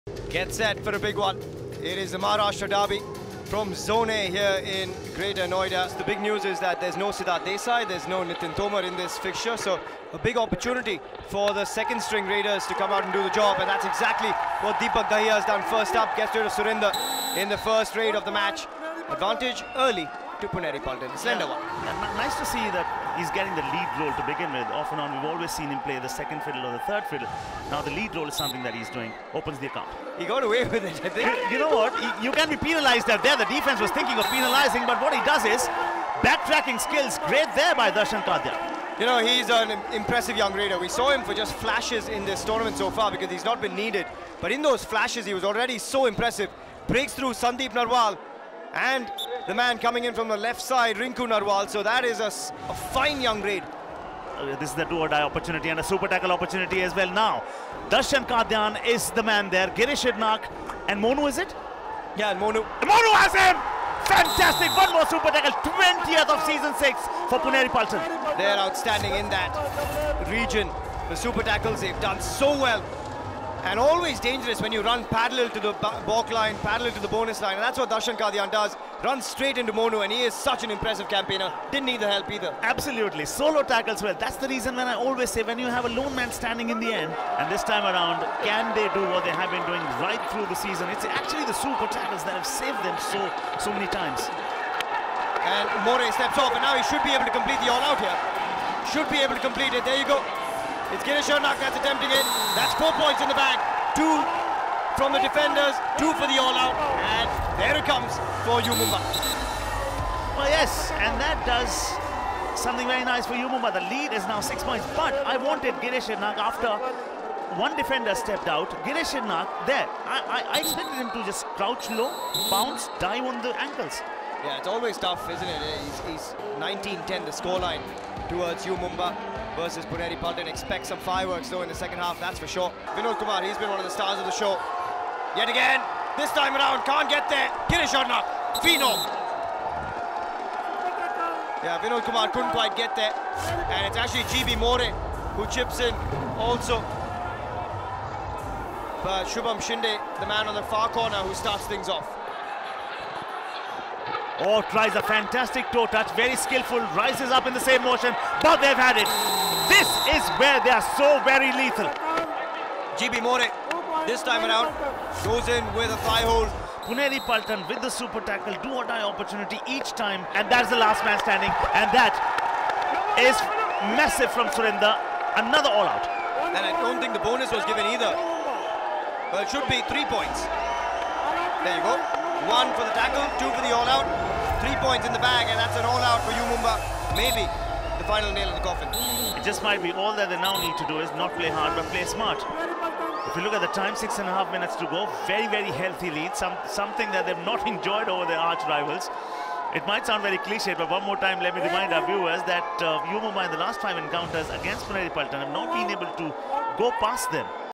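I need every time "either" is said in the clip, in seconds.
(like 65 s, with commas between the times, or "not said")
82 s, 177 s.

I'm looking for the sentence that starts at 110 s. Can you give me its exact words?
Well, yes, and that does something very nice for U Mumba.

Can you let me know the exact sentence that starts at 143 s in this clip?
And it's actually GB More who chips in also.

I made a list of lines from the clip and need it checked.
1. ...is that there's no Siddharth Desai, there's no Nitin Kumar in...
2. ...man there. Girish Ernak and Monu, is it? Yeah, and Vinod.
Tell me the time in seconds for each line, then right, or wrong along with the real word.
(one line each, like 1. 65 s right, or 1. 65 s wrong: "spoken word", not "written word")
1. 6 s wrong: "Tomar", not "Kumar"
2. 59 s wrong: "Monu", not "Vinod".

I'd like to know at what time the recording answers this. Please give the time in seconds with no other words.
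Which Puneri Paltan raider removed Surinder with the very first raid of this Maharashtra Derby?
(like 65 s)
14 s.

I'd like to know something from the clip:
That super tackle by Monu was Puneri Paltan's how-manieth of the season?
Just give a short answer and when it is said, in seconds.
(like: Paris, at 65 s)
20th, at 65 s.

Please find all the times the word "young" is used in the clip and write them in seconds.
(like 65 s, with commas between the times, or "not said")
40 s, 53 s.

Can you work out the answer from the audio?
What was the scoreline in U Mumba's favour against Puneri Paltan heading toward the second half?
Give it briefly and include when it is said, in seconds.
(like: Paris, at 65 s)
19-10, at 126 s.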